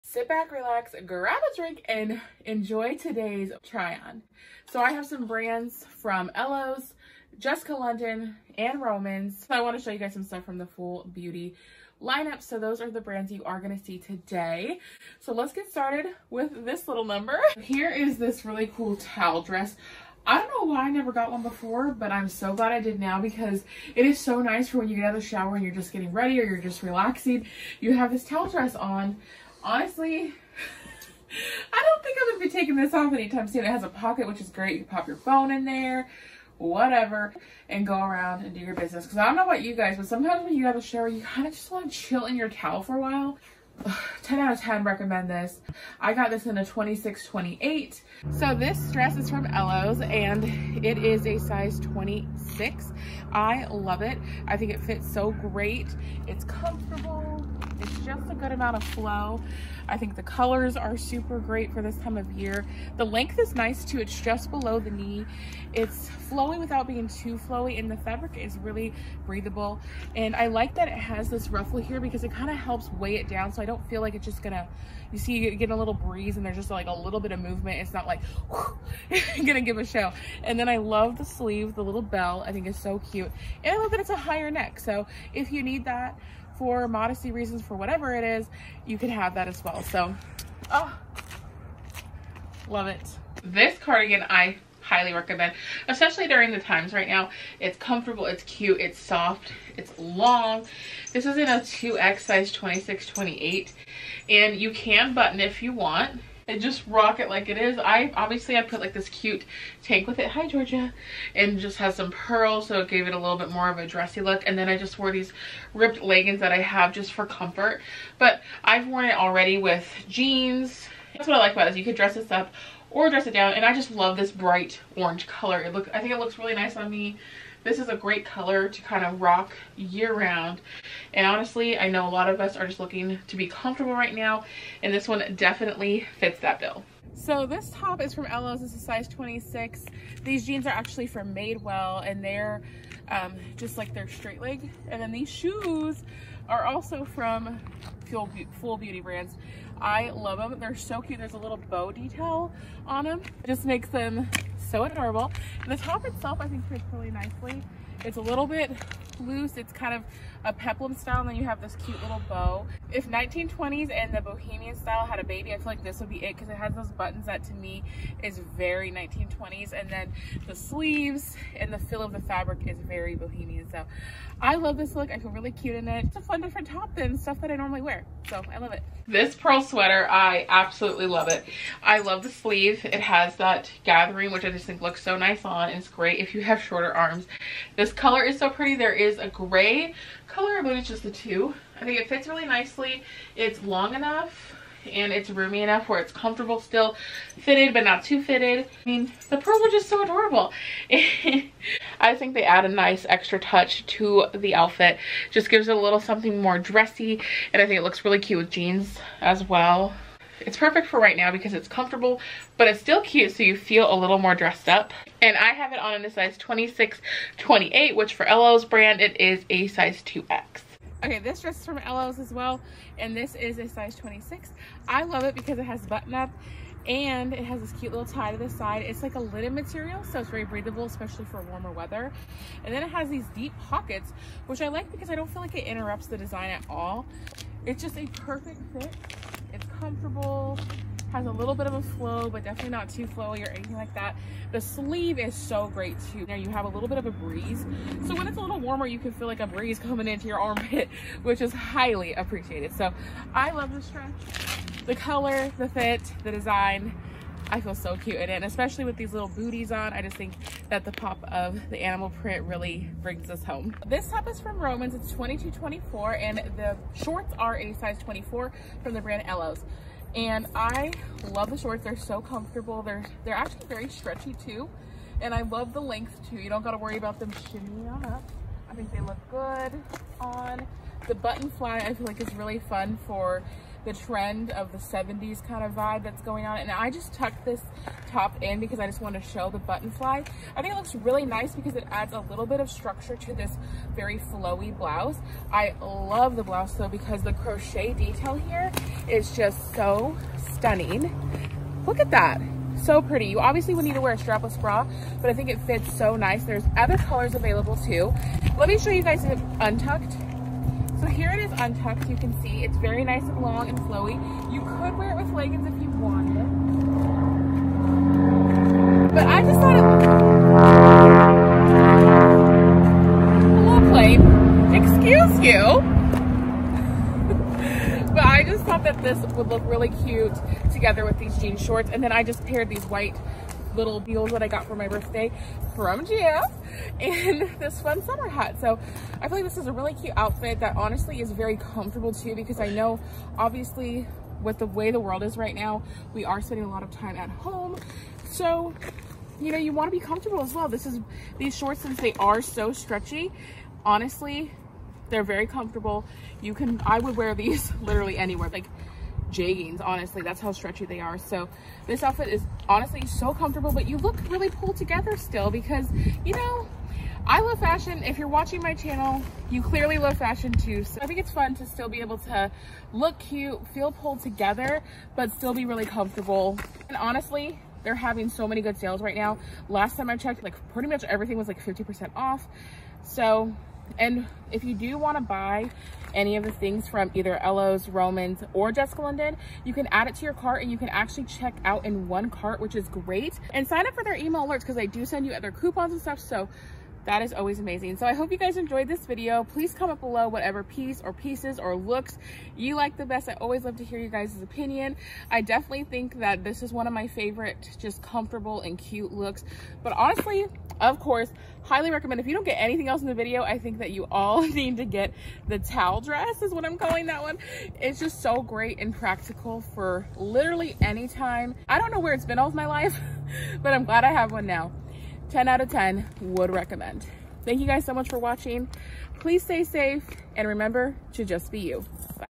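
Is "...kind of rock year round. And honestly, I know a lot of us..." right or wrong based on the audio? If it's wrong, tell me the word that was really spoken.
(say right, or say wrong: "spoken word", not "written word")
right.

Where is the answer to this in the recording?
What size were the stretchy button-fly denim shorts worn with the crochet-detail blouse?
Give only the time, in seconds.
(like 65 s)
267 s.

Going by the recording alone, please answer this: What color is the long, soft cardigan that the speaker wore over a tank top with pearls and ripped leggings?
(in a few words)
bright orange.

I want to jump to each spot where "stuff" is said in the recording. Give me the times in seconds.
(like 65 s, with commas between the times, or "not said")
10 s, 177 s, 396 s.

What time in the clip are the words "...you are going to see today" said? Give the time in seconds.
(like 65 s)
13 s.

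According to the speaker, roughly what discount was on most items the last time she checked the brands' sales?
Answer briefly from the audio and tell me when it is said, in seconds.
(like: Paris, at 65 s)
50%, at 381 s.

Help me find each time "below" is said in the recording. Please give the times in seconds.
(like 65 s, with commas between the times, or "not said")
64 s, 399 s.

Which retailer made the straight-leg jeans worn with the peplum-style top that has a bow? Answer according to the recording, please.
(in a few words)
Madewell.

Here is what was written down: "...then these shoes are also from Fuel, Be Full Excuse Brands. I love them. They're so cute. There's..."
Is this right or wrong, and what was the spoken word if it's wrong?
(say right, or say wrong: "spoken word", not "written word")
wrong: "Beauty", not "Excuse".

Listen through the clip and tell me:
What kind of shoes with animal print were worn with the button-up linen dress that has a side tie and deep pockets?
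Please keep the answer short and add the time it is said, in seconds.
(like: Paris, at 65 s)
booties, at 259 s.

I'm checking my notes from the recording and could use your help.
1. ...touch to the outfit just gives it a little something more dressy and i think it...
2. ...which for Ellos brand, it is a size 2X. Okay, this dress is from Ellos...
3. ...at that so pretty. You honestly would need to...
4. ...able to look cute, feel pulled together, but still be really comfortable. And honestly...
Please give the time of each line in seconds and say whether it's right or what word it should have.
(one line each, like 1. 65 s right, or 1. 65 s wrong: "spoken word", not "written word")
1. 203 s right
2. 217 s right
3. 301 s wrong: "obviously", not "honestly"
4. 372 s right.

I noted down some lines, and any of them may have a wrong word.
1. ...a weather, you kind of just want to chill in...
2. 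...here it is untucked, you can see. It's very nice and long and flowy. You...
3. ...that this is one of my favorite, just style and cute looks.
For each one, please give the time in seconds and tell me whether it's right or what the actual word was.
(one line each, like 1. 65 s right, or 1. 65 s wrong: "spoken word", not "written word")
1. 40 s wrong: "shower", not "weather"
2. 311 s right
3. 406 s wrong: "comfortable", not "style".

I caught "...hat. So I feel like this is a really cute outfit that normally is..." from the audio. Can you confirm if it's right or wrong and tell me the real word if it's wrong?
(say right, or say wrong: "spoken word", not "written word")
wrong: "honestly", not "normally".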